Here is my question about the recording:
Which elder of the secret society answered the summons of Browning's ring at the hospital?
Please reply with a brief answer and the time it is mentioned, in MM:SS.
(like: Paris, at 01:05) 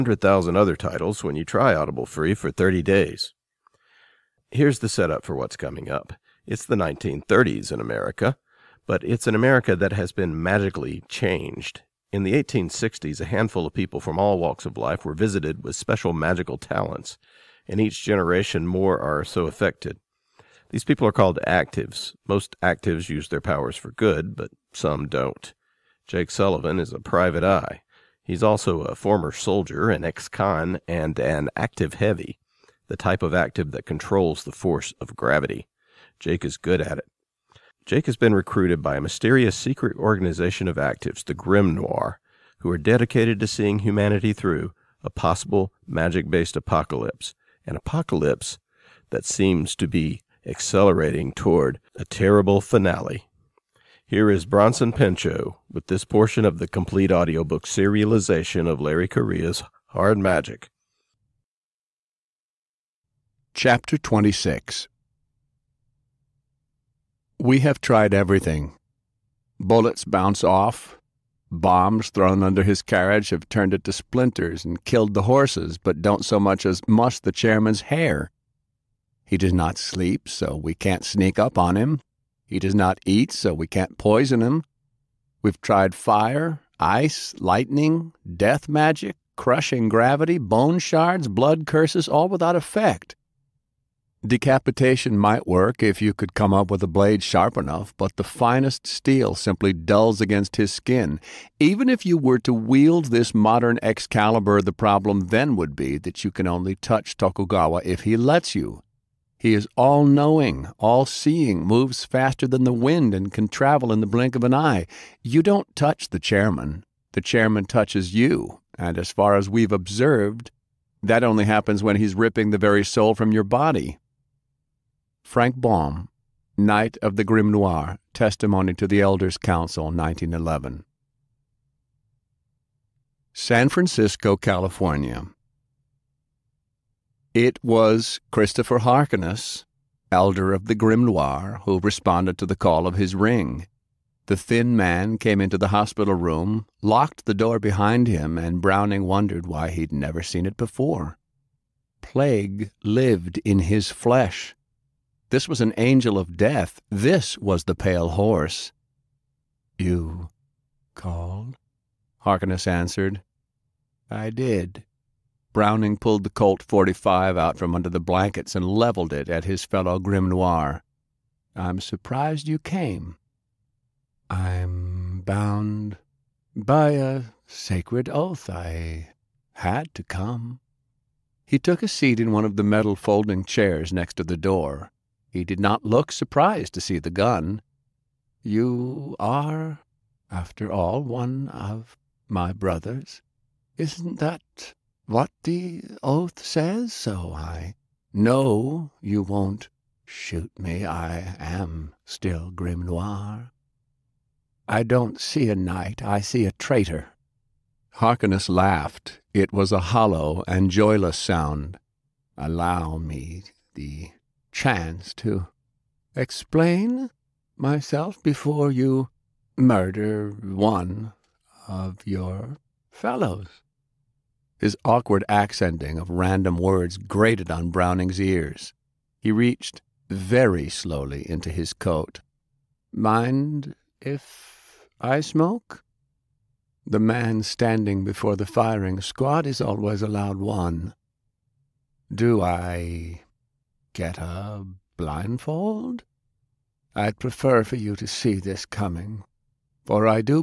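Christopher Harkness, at 02:18.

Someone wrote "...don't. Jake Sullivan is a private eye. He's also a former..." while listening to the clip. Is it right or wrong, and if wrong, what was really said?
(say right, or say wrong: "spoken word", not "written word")
right.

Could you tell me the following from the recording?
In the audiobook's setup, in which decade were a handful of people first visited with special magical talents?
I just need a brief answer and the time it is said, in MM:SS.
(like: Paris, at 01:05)
1860s, at 00:12.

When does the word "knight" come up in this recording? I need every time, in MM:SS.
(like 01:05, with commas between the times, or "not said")
02:06, 03:25.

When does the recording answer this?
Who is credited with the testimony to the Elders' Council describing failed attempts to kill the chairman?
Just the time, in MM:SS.
02:05.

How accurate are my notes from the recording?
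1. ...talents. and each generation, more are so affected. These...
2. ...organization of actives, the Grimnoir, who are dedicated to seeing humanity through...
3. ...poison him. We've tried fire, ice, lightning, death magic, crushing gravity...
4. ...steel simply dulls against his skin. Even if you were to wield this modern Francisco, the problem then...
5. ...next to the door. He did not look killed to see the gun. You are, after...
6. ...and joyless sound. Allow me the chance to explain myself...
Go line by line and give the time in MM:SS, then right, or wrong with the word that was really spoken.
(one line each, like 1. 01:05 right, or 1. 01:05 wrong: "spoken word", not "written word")
1. 00:16 right
2. 00:39 right
3. 01:23 right
4. 01:38 wrong: "Excalibur", not "Francisco"
5. 03:03 wrong: "surprised", not "killed"
6. 03:30 right.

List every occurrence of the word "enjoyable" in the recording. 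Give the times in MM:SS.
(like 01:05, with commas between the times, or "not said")
not said.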